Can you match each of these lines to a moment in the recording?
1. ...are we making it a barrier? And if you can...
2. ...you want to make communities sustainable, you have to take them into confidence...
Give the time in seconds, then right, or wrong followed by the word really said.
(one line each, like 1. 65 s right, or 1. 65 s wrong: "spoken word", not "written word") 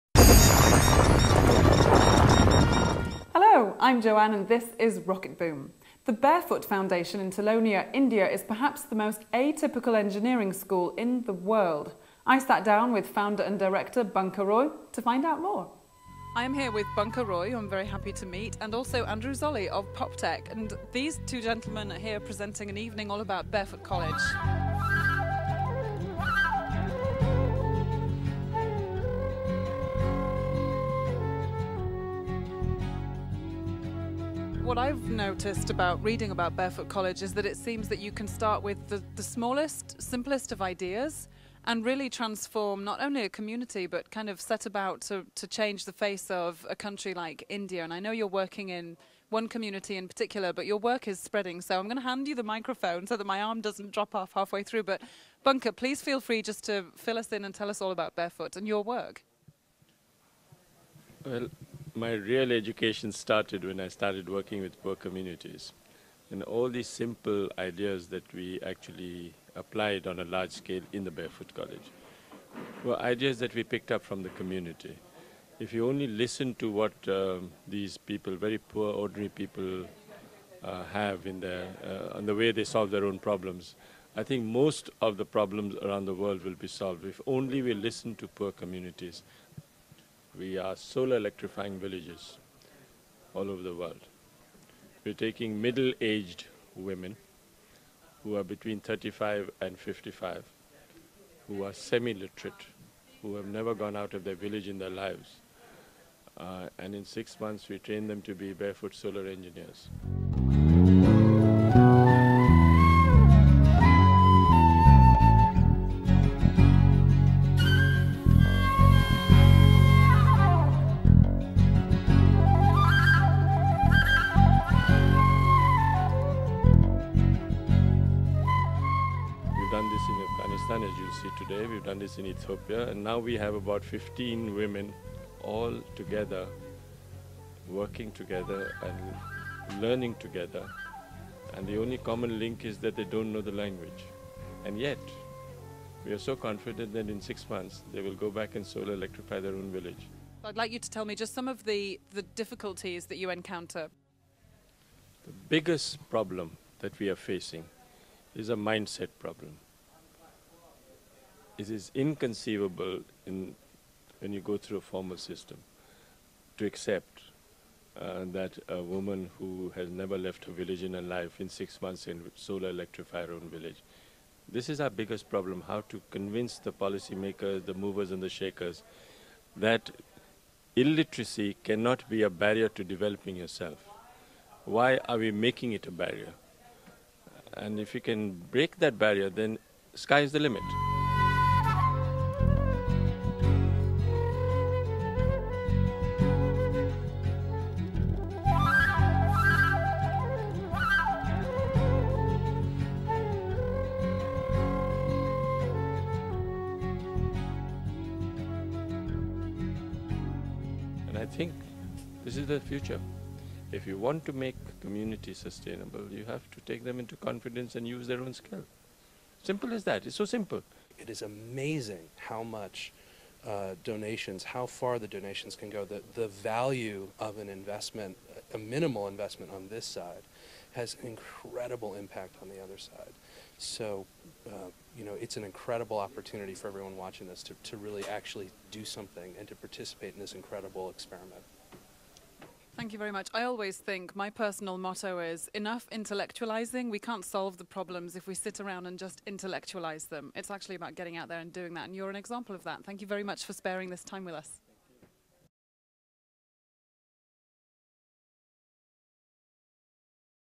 1. 185 s right
2. 213 s right.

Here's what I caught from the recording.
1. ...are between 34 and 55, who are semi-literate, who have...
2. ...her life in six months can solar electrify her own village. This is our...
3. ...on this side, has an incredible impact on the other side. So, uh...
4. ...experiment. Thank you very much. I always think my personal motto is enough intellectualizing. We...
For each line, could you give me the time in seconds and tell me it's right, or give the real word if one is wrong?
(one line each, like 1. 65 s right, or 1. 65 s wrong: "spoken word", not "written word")
1. 98 s wrong: "35", not "34"
2. 170 s right
3. 229 s right
4. 240 s right.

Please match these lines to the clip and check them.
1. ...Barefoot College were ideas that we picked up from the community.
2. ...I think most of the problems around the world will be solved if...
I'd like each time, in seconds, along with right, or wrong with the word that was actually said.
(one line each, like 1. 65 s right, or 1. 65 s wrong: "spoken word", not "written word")
1. 71 s right
2. 84 s right.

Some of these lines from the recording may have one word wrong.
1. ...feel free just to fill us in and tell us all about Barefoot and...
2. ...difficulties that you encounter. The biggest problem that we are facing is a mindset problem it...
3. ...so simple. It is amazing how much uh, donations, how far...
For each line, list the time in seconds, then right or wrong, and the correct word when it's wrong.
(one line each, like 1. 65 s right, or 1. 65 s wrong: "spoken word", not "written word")
1. 56 s right
2. 152 s right
3. 220 s right.